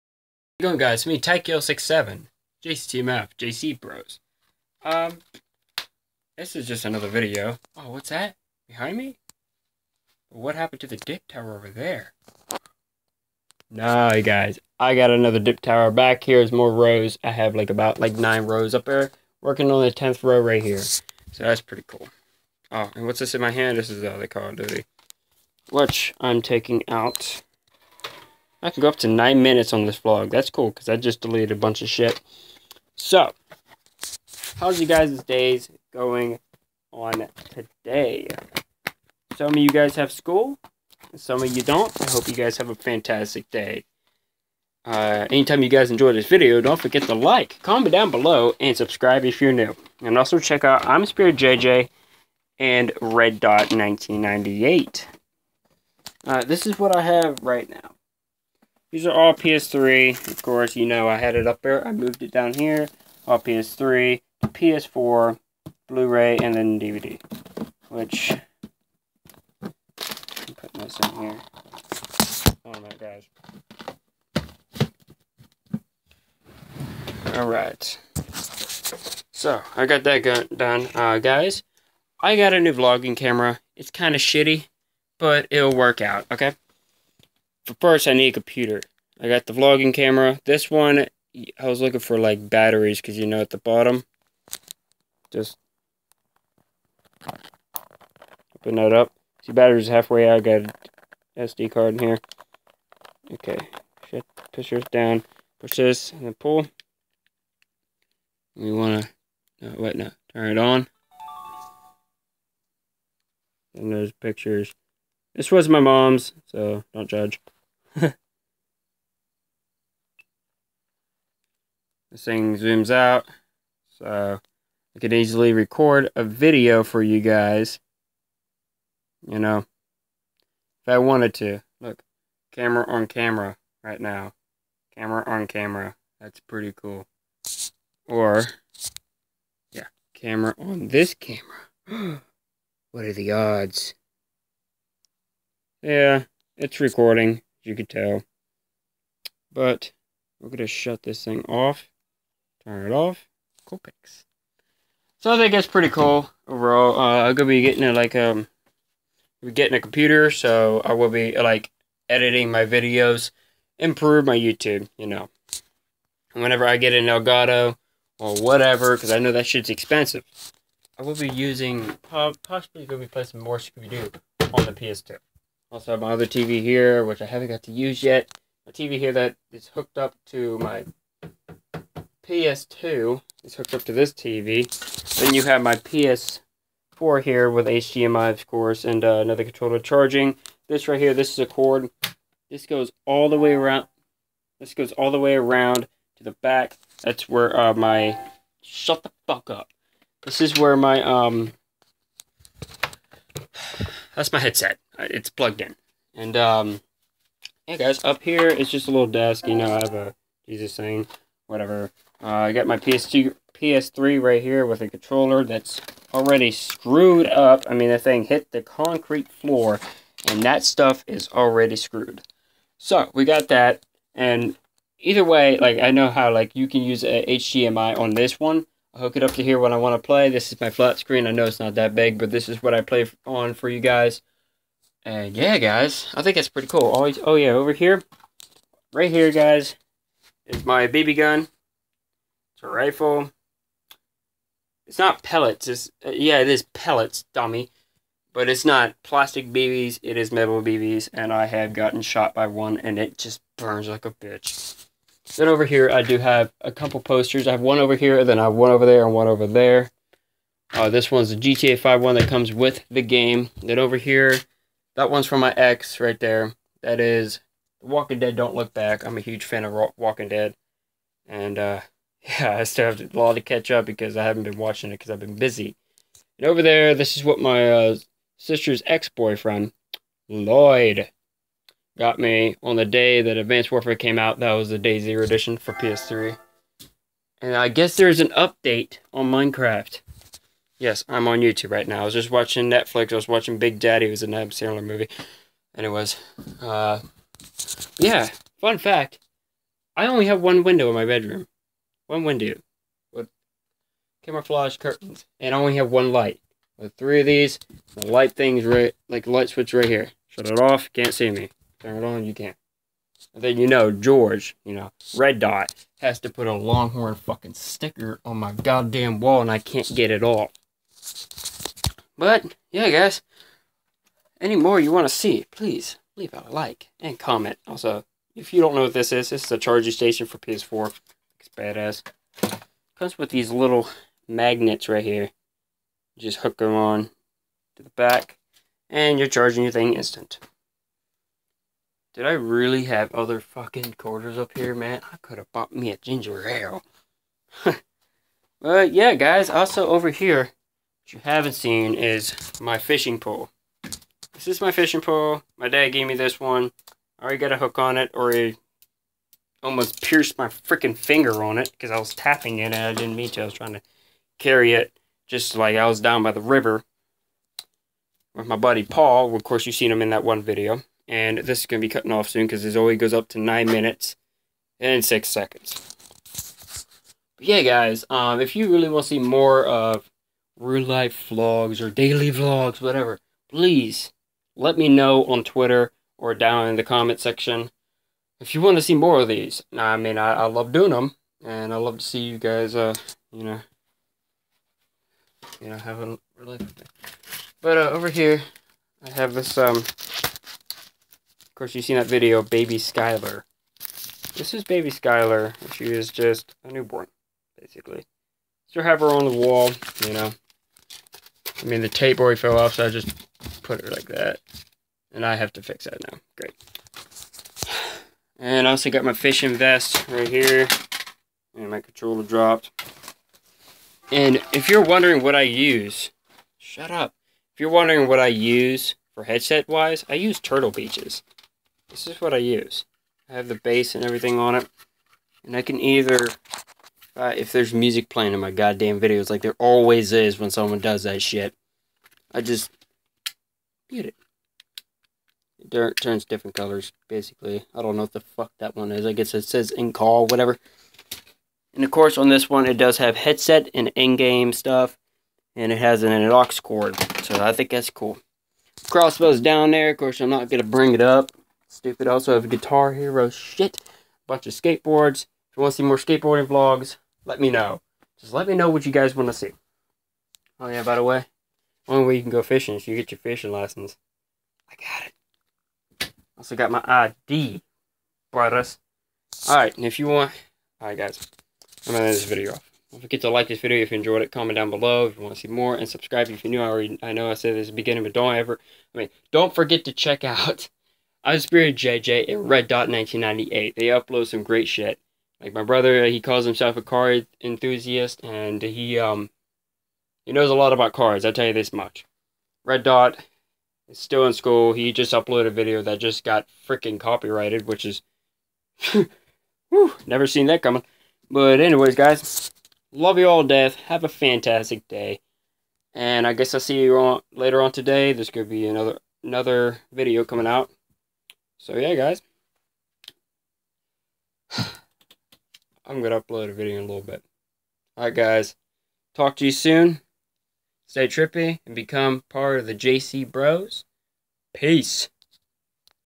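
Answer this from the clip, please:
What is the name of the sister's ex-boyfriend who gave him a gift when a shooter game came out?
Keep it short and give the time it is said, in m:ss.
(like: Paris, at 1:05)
Lloyd, at 4:40.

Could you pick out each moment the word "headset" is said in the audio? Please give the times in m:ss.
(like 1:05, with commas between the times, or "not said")
3:24, 7:09, 7:33.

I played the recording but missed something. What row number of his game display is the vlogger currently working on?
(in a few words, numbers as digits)
10.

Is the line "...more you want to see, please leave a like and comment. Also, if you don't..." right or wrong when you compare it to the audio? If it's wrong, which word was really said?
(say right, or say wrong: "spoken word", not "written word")
right.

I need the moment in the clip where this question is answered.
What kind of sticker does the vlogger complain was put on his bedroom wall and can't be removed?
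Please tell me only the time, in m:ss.
5:16.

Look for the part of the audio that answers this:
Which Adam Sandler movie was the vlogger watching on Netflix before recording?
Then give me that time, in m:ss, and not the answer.
4:53.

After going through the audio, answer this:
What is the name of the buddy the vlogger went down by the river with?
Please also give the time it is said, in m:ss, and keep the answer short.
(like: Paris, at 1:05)
Paul, at 6:08.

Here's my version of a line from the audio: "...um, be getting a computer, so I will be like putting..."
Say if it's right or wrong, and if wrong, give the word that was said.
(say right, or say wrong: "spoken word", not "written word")
wrong: "editing", not "putting".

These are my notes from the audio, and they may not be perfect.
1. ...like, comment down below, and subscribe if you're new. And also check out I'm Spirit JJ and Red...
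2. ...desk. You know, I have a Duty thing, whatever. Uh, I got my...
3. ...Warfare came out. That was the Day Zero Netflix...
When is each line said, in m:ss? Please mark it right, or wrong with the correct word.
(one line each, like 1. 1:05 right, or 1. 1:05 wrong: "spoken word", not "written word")
1. 0:47 right
2. 3:29 wrong: "Jesus", not "Duty"
3. 4:43 wrong: "Edition", not "Netflix".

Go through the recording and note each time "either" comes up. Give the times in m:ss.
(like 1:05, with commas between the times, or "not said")
3:44, 7:15.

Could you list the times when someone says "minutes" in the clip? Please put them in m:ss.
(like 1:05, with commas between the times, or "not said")
0:29, 6:13.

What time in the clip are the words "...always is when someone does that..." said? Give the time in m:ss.
7:19.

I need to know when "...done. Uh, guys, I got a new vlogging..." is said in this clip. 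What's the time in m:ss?
1:20.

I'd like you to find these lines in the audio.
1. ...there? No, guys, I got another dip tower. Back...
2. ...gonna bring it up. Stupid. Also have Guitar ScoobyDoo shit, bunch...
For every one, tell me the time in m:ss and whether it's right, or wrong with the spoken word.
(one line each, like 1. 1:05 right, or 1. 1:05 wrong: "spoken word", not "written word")
1. 0:11 right
2. 7:40 wrong: "Hero", not "ScoobyDoo".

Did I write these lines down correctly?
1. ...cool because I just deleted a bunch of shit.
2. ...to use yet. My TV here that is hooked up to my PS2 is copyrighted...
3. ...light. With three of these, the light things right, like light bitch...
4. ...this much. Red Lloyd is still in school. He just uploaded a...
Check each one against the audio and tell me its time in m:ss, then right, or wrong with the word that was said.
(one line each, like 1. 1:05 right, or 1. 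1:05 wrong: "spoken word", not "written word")
1. 0:30 right
2. 2:57 wrong: "hooked", not "copyrighted"
3. 5:06 wrong: "switch", not "bitch"
4. 8:21 wrong: "Dot", not "Lloyd".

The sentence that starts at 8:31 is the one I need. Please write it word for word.
But anyways, guys, love you all death.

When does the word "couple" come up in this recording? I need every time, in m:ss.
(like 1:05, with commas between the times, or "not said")
4:16.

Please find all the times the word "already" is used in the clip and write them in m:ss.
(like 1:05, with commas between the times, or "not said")
3:36, 3:41, 5:57, 6:52, 8:06.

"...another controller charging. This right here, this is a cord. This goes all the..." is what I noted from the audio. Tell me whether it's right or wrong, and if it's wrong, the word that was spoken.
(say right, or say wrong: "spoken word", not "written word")
right.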